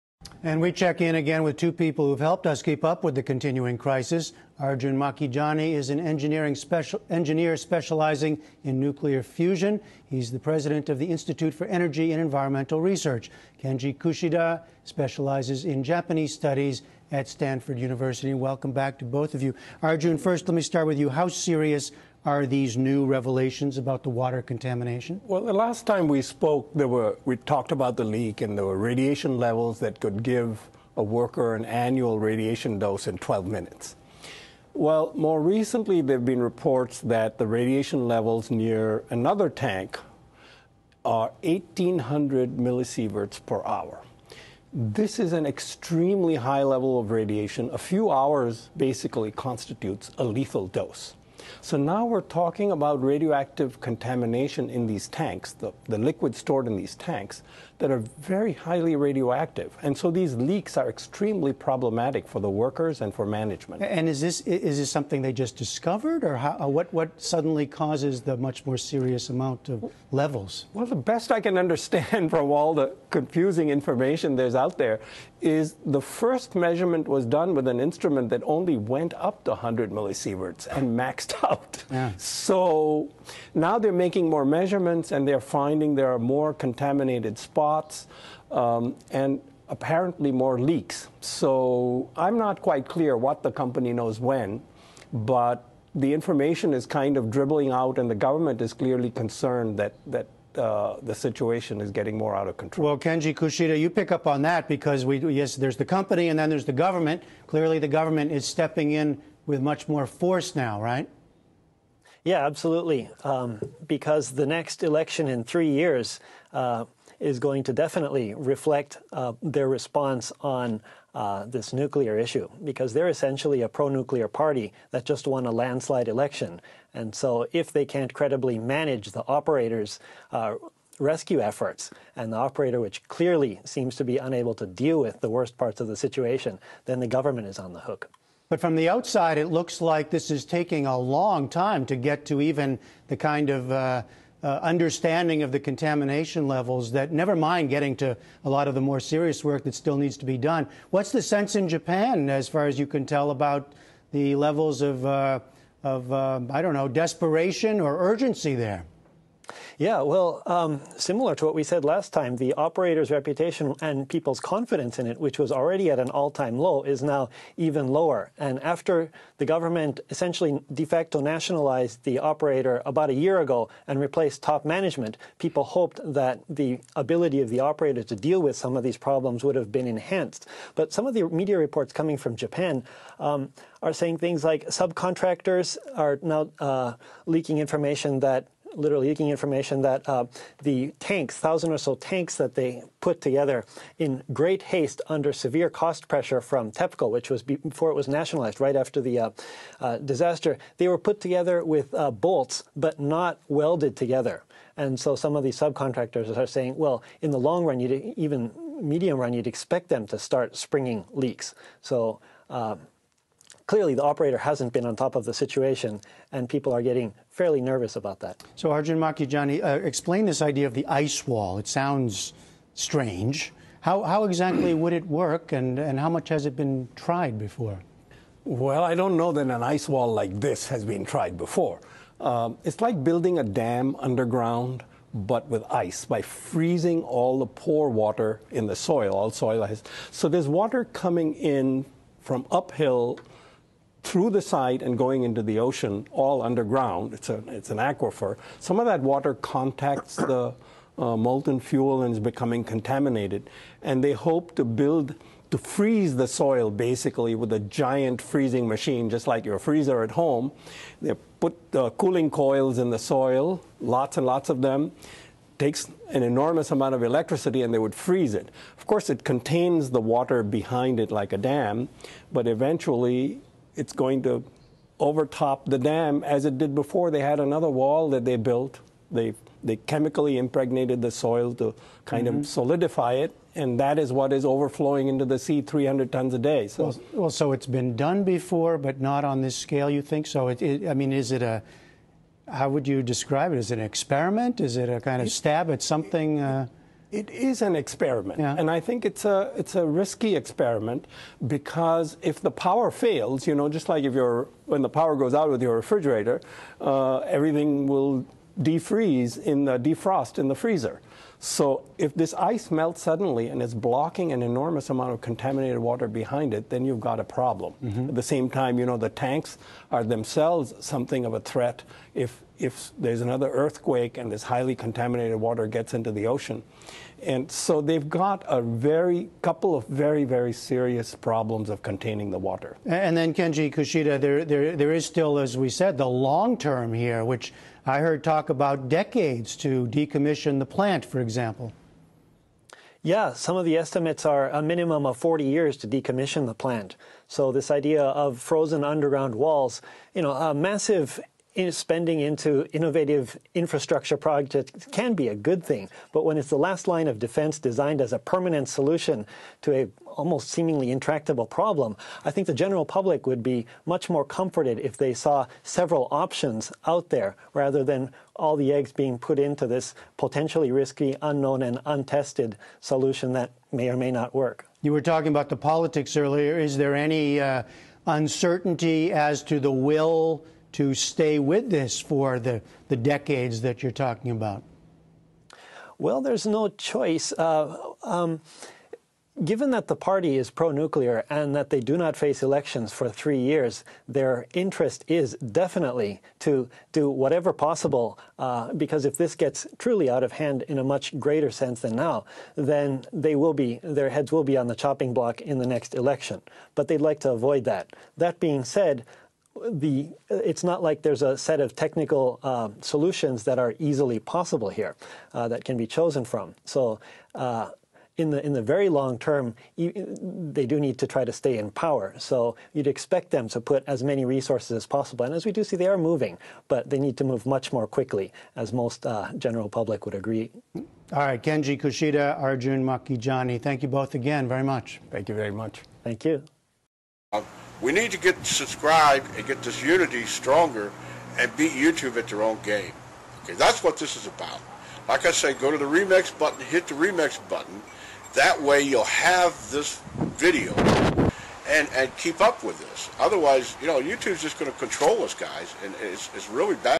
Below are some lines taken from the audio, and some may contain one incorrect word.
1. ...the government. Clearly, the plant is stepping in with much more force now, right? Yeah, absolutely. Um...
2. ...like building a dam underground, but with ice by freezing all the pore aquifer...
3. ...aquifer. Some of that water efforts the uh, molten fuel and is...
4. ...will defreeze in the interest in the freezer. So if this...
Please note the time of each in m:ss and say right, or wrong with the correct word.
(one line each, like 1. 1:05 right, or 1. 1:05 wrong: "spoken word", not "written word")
1. 1:46 wrong: "government", not "plant"
2. 3:52 wrong: "water", not "aquifer"
3. 4:07 wrong: "contacts", not "efforts"
4. 5:07 wrong: "defrost", not "interest".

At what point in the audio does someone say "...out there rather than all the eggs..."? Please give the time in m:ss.
6:06.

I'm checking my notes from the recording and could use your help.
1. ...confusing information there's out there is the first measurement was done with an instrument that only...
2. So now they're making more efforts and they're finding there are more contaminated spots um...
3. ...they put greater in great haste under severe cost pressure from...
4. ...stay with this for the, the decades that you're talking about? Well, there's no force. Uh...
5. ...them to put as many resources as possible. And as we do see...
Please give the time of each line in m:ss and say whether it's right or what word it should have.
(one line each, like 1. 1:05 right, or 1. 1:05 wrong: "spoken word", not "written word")
1. 1:13 right
2. 1:22 wrong: "measurements", not "efforts"
3. 3:12 wrong: "together", not "greater"
4. 6:20 wrong: "choice", not "force"
5. 7:03 right.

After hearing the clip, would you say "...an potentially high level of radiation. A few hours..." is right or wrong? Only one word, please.
wrong.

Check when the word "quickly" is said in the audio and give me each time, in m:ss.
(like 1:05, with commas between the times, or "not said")
7:07.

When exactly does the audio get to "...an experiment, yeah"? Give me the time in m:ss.
4:57.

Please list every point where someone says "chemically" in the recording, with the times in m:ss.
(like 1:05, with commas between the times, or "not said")
4:39.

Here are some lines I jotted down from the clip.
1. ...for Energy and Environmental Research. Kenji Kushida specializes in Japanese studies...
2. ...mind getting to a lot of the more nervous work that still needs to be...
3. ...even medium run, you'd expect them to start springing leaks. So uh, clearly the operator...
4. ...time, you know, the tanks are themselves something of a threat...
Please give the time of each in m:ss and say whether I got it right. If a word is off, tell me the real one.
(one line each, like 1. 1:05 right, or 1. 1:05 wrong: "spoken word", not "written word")
1. 0:11 right
2. 2:27 wrong: "serious", not "nervous"
3. 3:28 right
4. 5:18 right.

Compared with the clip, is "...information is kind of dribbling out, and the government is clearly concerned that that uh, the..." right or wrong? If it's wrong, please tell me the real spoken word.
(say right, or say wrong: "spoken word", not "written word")
right.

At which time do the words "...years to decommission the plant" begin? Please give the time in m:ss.
5:45.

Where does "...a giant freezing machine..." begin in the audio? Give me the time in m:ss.
4:17.